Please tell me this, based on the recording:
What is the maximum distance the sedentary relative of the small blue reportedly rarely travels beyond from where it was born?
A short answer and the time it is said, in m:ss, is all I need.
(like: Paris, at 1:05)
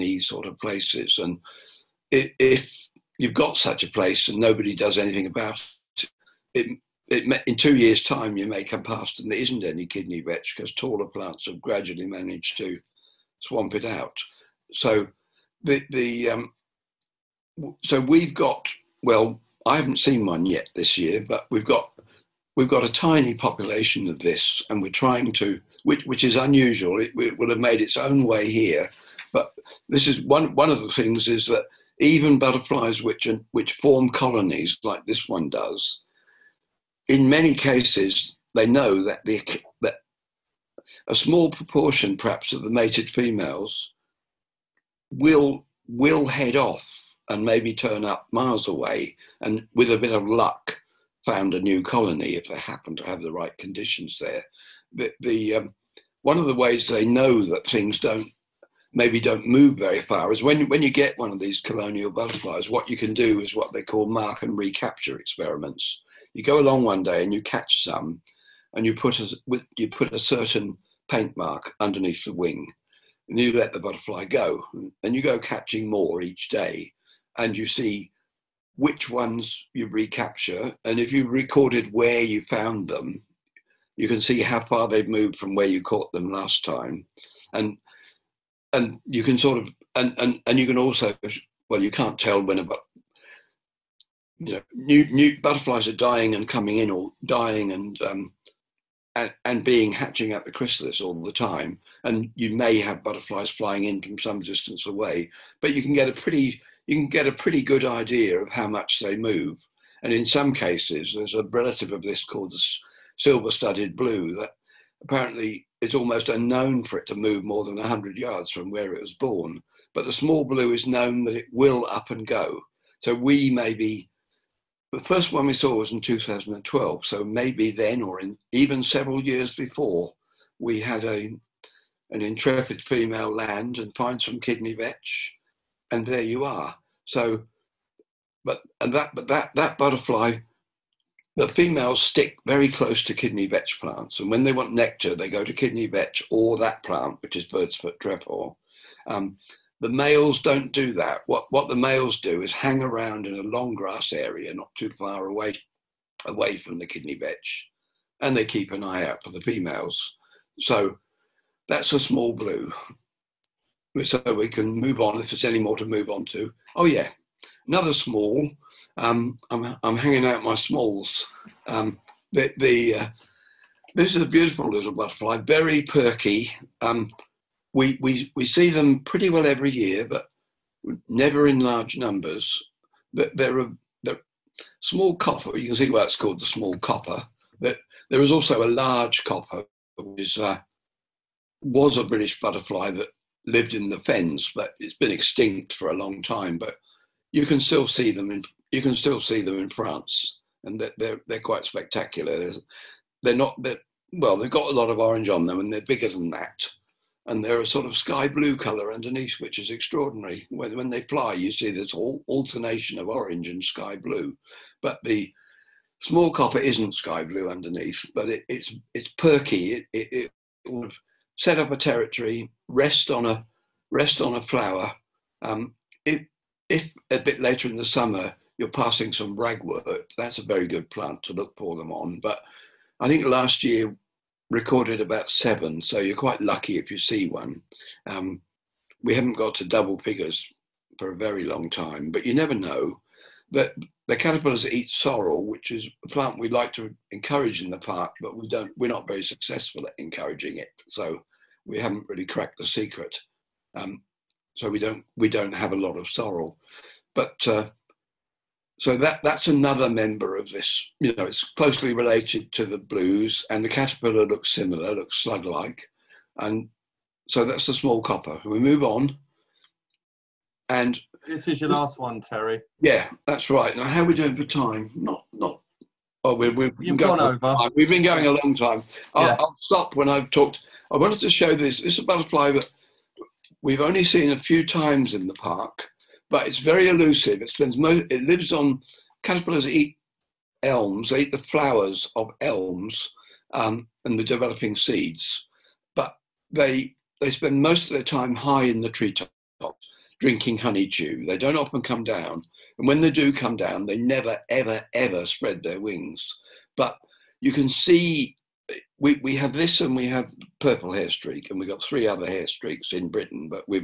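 100 yards, at 1:57.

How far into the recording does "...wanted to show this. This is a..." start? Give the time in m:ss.
4:40.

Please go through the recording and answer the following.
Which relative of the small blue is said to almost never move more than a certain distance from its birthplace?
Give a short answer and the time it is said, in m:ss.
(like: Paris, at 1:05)
Silver studded blue, at 1:53.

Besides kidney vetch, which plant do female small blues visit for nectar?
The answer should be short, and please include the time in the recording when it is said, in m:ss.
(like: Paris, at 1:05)
Bird's foot trefoil, at 2:27.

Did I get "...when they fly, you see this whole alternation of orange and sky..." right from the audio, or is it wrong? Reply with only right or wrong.
right.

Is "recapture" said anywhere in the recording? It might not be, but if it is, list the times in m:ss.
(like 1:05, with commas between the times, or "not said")
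1:04, 1:19.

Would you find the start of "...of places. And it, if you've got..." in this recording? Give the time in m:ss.
0:00.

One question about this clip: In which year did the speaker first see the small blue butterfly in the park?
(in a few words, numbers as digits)
2012.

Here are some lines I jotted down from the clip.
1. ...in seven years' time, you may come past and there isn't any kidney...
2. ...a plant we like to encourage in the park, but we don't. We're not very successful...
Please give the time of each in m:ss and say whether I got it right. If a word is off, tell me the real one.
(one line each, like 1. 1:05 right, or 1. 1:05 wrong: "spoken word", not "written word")
1. 0:07 wrong: "two", not "seven"
2. 4:06 right.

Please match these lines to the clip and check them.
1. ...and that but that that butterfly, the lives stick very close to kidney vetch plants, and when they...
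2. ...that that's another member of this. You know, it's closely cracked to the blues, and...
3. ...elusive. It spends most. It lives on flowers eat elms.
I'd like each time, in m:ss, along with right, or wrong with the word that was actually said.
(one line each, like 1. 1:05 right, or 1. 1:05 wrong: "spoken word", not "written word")
1. 2:18 wrong: "females", not "lives"
2. 4:18 wrong: "related", not "cracked"
3. 4:46 wrong: "caterpillars", not "flowers".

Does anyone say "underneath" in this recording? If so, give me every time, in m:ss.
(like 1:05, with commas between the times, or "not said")
1:11, 3:28, 3:37.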